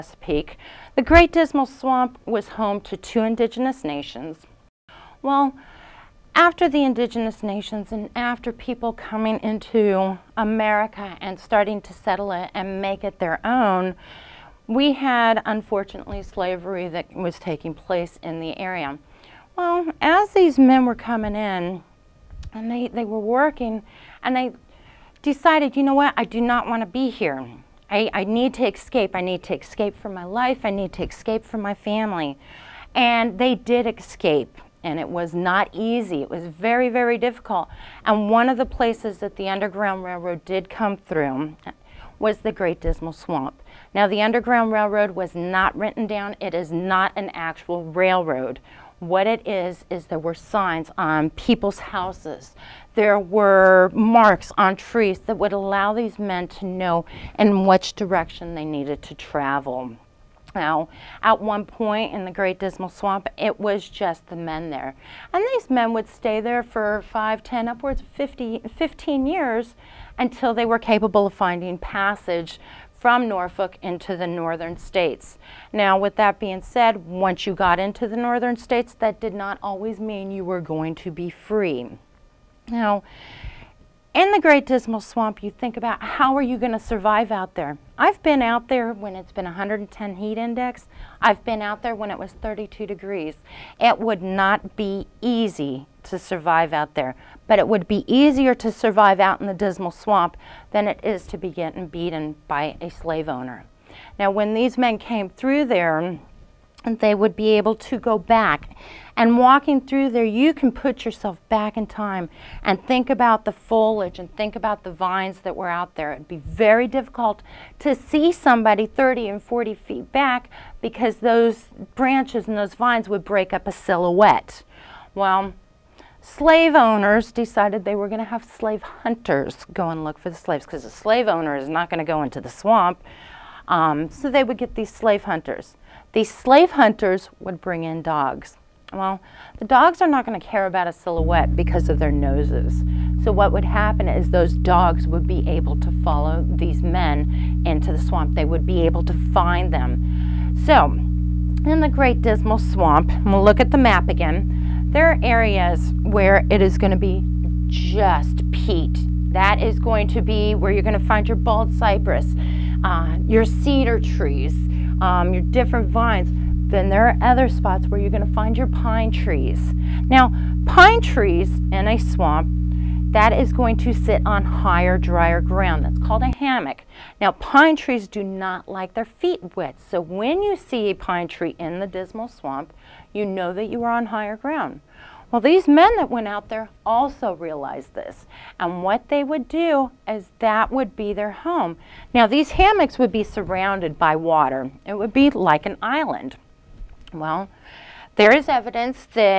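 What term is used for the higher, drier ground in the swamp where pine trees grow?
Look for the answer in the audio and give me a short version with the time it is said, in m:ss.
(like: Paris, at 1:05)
hammock, at 2:56.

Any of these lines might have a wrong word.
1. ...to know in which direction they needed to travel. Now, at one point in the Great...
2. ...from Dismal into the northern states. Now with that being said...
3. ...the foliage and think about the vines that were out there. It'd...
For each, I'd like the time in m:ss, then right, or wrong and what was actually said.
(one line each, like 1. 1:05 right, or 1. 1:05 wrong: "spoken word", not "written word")
1. 0:56 right
2. 1:12 wrong: "Norfolk", not "Dismal"
3. 1:53 right.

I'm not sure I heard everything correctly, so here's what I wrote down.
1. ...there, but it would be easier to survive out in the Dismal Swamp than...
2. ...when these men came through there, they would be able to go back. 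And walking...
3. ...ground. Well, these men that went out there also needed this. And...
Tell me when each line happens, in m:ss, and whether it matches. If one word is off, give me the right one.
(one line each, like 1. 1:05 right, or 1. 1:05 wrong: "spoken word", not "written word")
1. 1:36 right
2. 1:44 right
3. 3:04 wrong: "realized", not "needed".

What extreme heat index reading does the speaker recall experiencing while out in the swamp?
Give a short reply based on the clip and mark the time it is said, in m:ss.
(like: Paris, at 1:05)
110, at 1:29.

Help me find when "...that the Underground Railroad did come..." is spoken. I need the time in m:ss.
0:39.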